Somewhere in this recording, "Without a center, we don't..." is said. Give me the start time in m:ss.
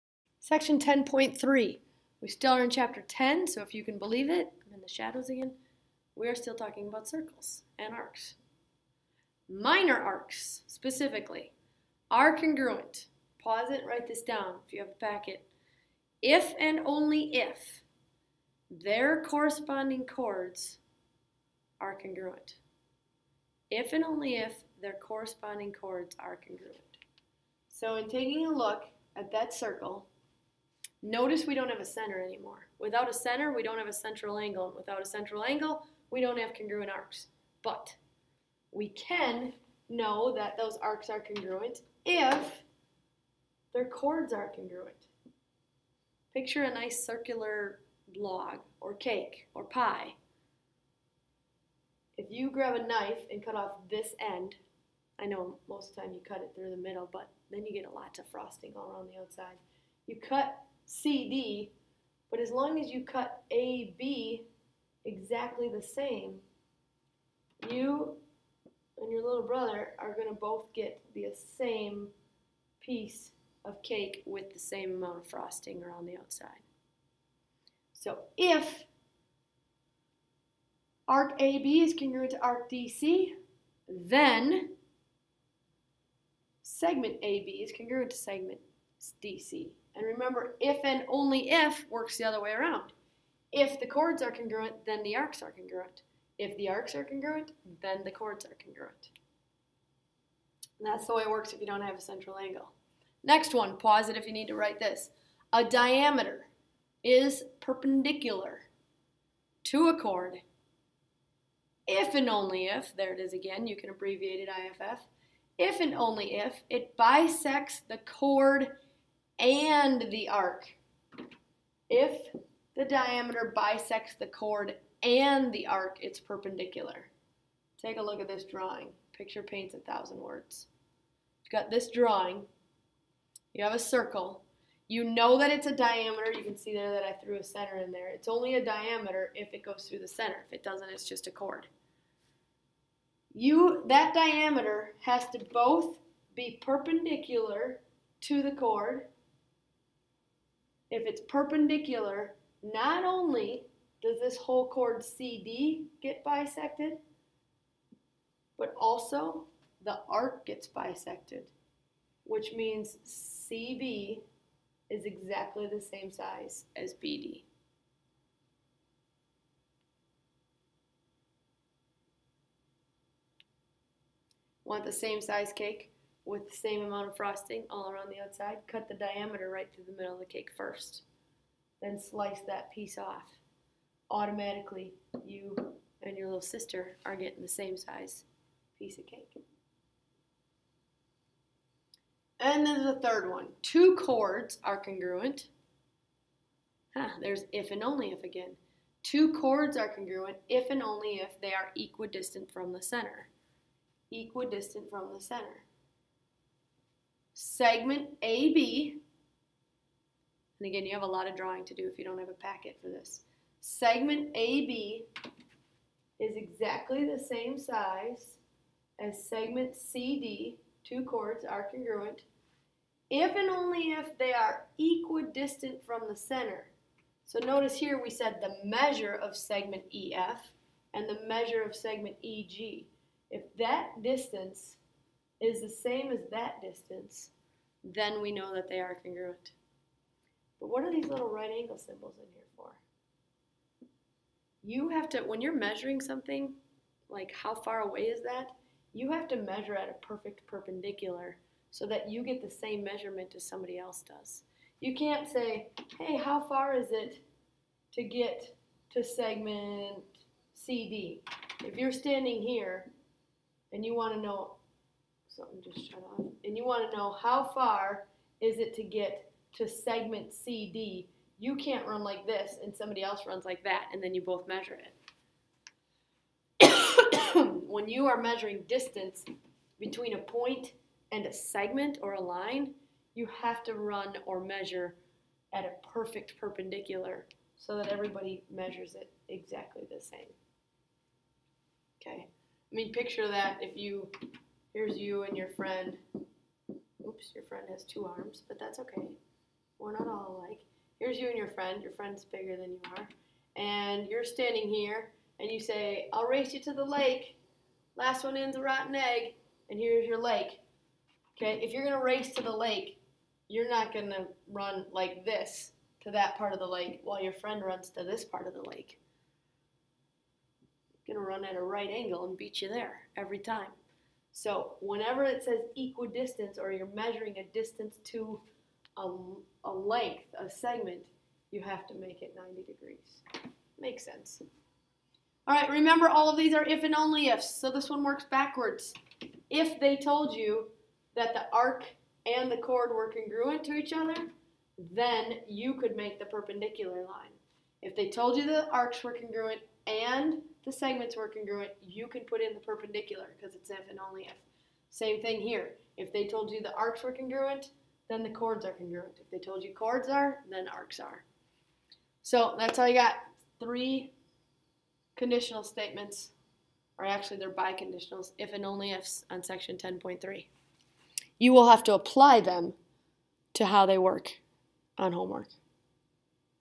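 0:32.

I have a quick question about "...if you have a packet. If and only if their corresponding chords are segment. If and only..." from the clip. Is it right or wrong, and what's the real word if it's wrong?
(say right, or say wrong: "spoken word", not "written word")
wrong: "congruent", not "segment".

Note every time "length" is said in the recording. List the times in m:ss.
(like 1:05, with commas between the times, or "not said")
5:29.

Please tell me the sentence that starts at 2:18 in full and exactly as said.
It's only a diameter if it goes through the center.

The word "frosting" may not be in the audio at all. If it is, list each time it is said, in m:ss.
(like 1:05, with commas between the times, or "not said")
0:58, 1:15, 2:57.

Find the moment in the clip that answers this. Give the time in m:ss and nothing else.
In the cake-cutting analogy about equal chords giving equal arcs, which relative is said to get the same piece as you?
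1:09.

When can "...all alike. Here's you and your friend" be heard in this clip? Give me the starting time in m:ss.
5:00.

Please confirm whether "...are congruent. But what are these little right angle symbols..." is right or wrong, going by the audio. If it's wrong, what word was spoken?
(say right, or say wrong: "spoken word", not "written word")
right.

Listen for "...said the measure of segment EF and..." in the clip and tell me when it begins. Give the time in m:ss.
3:48.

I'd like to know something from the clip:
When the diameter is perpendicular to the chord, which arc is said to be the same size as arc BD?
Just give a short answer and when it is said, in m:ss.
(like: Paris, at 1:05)
CB, at 2:43.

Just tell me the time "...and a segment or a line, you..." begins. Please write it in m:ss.
4:41.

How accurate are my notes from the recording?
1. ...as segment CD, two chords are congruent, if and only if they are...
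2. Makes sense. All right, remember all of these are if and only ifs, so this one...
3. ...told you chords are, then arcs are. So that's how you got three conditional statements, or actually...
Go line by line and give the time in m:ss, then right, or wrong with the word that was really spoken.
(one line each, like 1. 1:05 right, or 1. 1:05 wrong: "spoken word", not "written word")
1. 3:38 right
2. 5:33 right
3. 5:59 right.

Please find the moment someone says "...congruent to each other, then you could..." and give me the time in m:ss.
5:43.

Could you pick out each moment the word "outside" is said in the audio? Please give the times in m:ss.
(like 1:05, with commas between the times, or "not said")
0:59, 1:16, 2:58.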